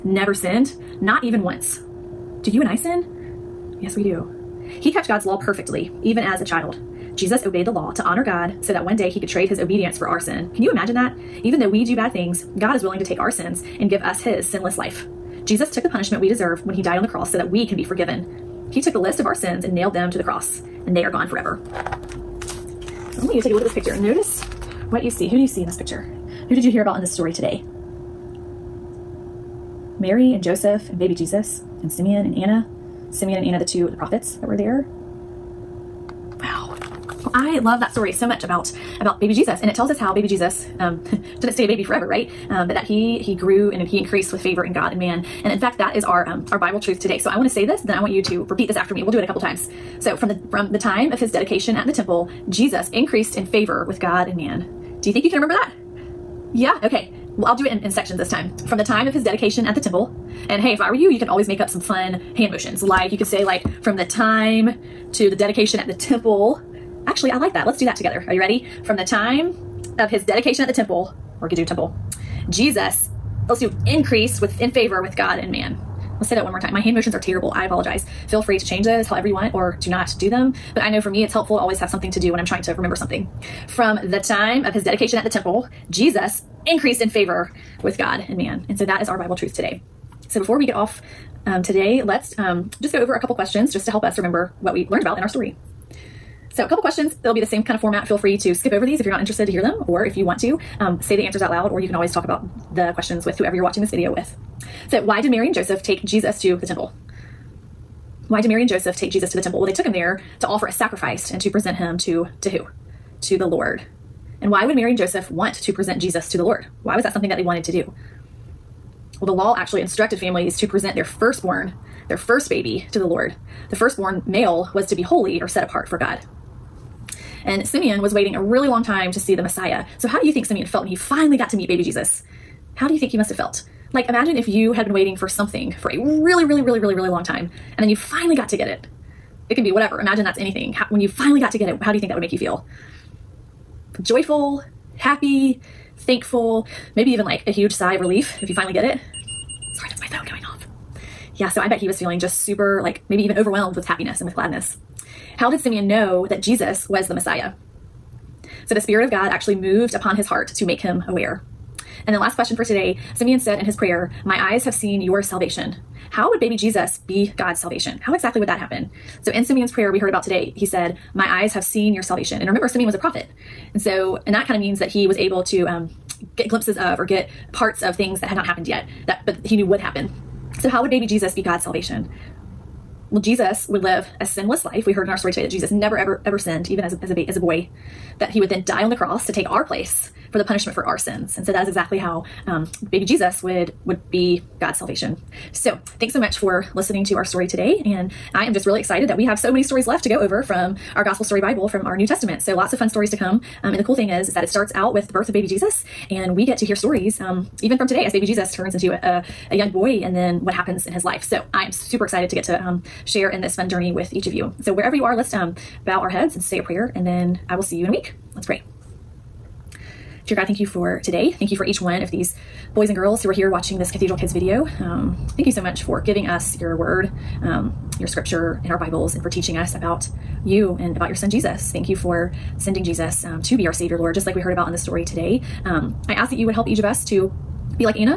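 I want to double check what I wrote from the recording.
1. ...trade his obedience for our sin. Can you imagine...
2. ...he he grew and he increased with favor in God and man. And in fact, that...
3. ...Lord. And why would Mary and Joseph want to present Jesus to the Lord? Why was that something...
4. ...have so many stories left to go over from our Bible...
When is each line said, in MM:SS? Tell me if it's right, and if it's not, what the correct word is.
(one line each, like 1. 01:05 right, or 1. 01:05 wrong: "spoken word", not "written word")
1. 00:09 right
2. 00:42 right
3. 01:53 right
4. 03:19 wrong: "Gospel", not "Bible".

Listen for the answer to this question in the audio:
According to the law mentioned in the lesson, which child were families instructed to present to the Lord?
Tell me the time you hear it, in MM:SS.
02:00.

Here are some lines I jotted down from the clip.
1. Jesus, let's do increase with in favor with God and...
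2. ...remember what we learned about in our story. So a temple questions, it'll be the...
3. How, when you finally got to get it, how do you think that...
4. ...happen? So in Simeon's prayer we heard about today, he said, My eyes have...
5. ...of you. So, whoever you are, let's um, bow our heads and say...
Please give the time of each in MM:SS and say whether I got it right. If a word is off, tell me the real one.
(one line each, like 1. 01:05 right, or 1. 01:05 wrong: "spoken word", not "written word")
1. 01:12 right
2. 01:34 wrong: "couple", not "temple"
3. 02:20 right
4. 02:48 right
5. 03:34 wrong: "wherever", not "whoever".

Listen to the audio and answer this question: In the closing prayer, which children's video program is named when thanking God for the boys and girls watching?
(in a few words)
Cathedral Kids.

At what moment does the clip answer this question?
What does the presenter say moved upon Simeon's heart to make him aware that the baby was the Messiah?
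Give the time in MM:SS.
02:38.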